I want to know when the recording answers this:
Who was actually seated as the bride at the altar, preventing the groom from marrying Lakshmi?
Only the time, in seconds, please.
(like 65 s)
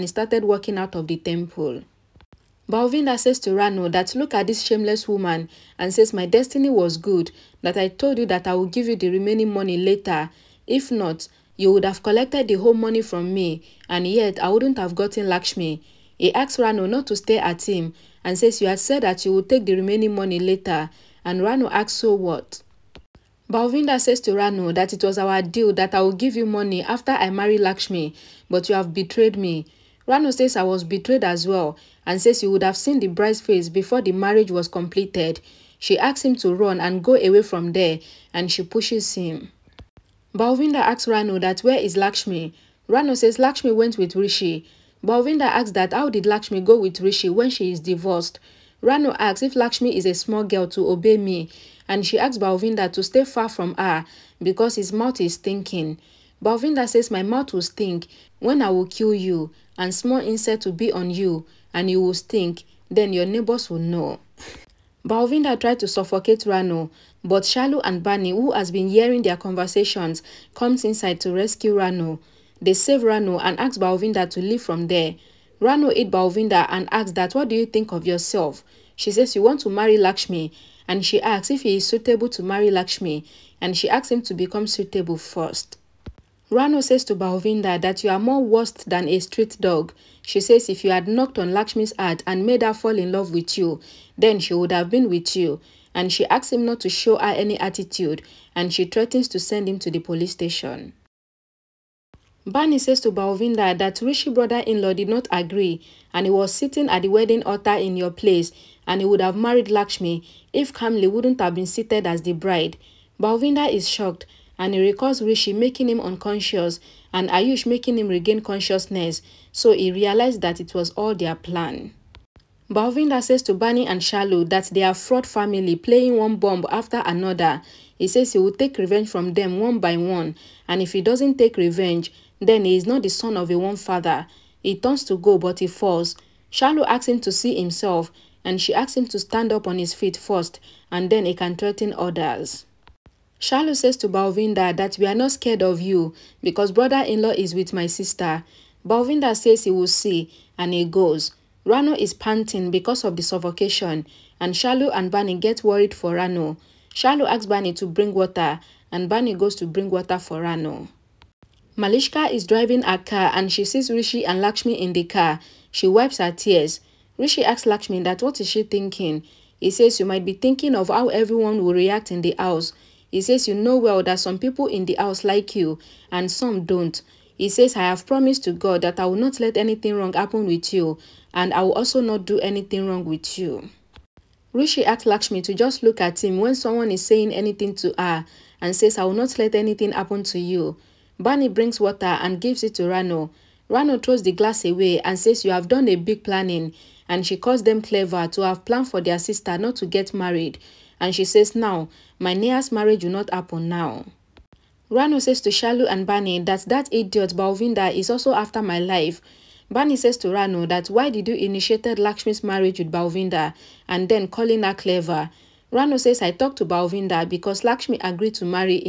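110 s.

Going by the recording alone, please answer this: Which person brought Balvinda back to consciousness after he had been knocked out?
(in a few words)
Ayush.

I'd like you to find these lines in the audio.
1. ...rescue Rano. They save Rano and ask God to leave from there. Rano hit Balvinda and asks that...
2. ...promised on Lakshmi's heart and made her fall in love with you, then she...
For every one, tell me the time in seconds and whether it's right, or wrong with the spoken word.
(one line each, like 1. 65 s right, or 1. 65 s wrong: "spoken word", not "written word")
1. 71 s wrong: "Balvinda", not "God"
2. 91 s wrong: "knocked", not "promised".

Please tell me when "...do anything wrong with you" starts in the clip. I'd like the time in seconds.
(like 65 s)
182 s.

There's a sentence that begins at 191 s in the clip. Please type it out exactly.
Bani brings water and gives it to Rano.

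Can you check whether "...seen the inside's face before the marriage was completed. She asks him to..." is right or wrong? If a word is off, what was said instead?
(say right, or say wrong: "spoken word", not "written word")
wrong: "bride", not "inside".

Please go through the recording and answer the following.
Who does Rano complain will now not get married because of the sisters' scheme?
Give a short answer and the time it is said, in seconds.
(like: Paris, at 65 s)
Neha, at 202 s.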